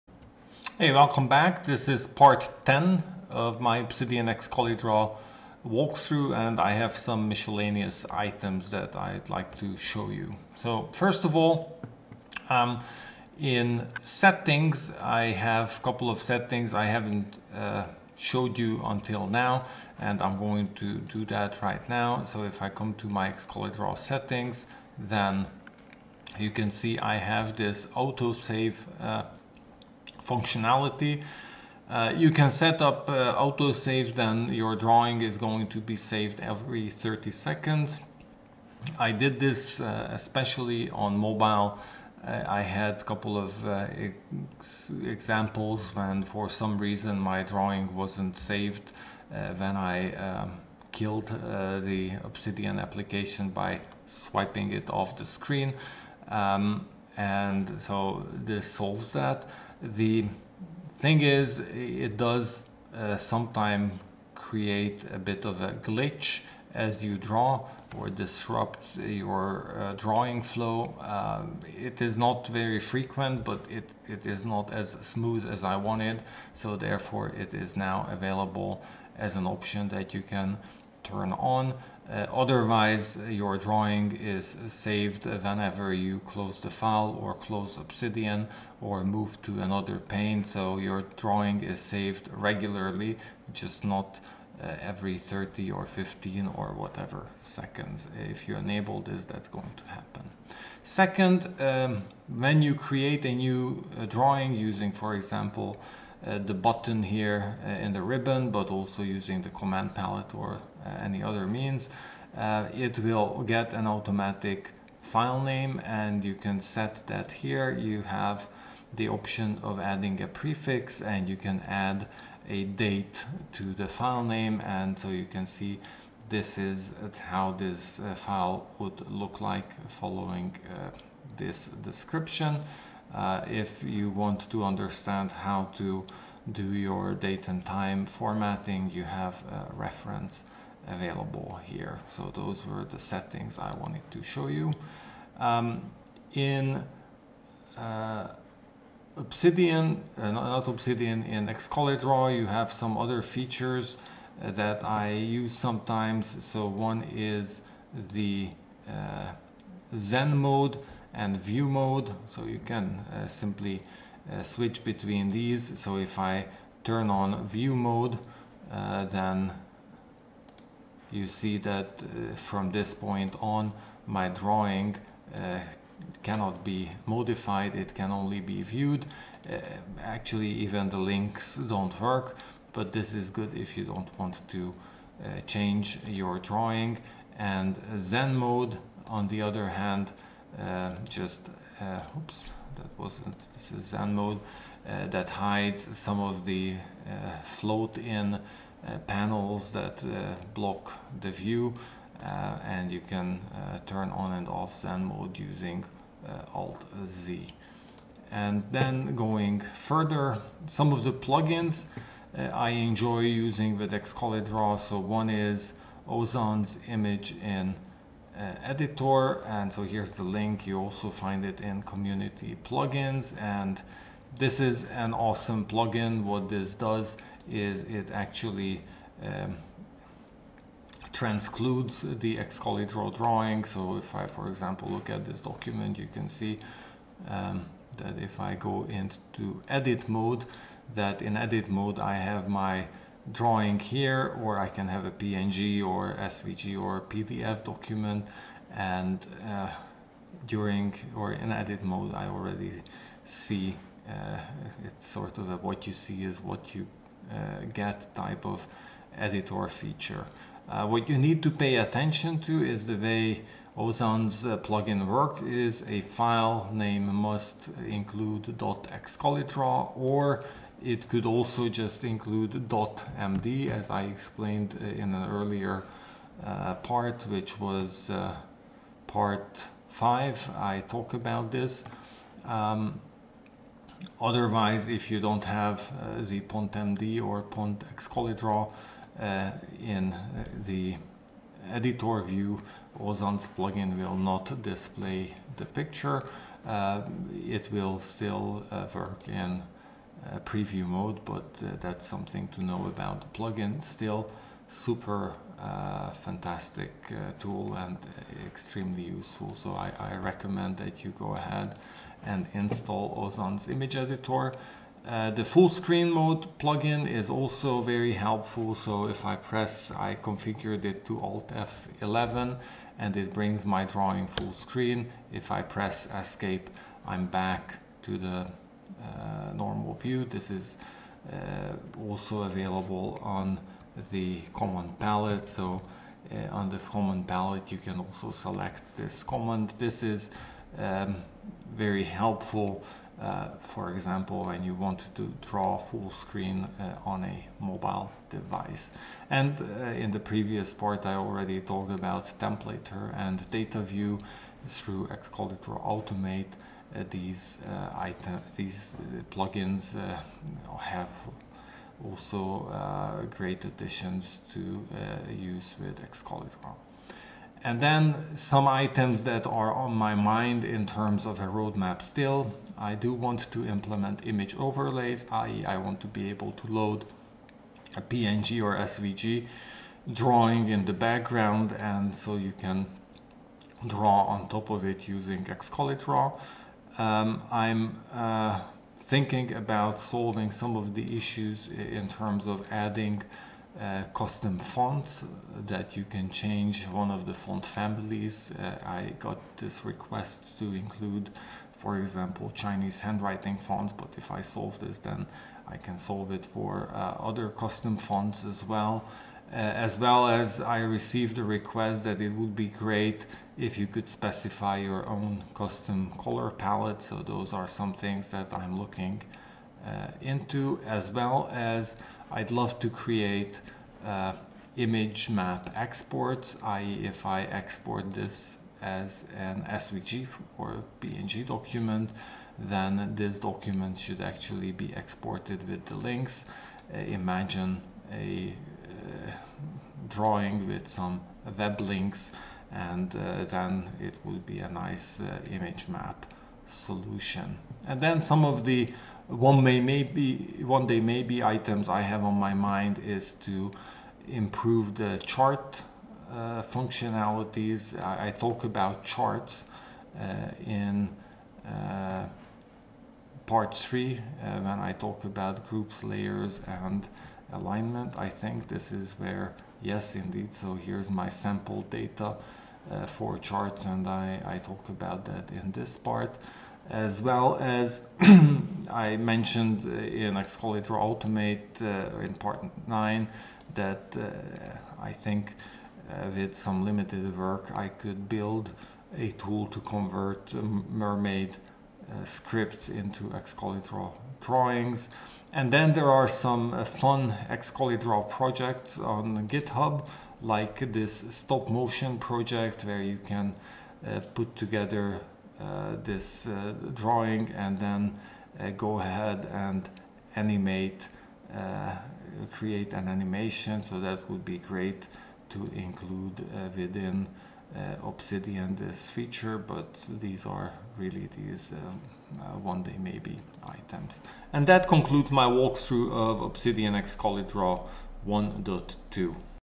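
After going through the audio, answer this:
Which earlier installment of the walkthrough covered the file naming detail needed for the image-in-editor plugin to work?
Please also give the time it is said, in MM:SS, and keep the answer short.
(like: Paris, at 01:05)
Part 5, at 04:39.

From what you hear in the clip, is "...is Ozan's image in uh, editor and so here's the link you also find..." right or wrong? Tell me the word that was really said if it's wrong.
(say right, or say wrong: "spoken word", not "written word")
right.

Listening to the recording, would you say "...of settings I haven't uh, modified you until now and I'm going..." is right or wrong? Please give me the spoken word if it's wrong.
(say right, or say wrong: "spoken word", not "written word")
wrong: "showed", not "modified".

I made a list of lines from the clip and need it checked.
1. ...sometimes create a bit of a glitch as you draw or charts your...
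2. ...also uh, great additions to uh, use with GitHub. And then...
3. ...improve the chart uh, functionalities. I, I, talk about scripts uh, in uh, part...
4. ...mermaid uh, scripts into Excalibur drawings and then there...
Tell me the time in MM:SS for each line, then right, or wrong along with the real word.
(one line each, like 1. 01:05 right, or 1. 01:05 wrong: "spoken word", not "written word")
1. 01:03 wrong: "disrupts", not "charts"
2. 06:02 wrong: "Excalidraw", not "GitHub"
3. 07:34 wrong: "charts", not "scripts"
4. 08:10 right.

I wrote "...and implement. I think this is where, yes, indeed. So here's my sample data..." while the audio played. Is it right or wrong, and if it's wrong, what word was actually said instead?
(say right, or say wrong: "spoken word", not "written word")
wrong: "alignment", not "implement".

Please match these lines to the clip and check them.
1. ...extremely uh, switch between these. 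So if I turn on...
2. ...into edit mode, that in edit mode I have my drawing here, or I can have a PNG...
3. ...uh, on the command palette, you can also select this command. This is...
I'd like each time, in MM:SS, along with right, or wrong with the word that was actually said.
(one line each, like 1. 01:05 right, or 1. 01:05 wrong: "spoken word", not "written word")
1. 02:43 wrong: "simply", not "extremely"
2. 03:58 right
3. 05:36 right.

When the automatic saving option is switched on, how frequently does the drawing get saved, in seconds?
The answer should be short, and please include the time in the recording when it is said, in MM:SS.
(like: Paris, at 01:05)
30, at 00:36.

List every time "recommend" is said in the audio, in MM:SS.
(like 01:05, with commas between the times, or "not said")
05:10.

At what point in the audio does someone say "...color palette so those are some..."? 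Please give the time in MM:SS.
06:56.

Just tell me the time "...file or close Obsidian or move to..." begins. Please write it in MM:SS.
01:26.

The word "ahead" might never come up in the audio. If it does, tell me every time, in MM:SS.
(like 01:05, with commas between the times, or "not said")
05:11, 08:28.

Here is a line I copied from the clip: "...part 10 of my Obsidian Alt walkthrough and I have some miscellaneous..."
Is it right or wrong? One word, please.
wrong.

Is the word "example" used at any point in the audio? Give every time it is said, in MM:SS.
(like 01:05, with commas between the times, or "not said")
00:45, 01:45, 03:54, 05:43, 06:41.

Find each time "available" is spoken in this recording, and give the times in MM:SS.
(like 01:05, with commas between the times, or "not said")
01:18, 02:20, 05:32.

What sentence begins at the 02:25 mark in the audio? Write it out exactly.
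Um, in uh, Obsidian, uh, not Obsidian, in Excalidraw you have some other features uh, that I use sometimes.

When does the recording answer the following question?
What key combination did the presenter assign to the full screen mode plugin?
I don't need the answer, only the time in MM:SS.
05:21.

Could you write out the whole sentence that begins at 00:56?
Um, and so this solves that.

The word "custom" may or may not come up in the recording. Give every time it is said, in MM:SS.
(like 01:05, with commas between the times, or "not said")
06:34, 06:47, 06:55.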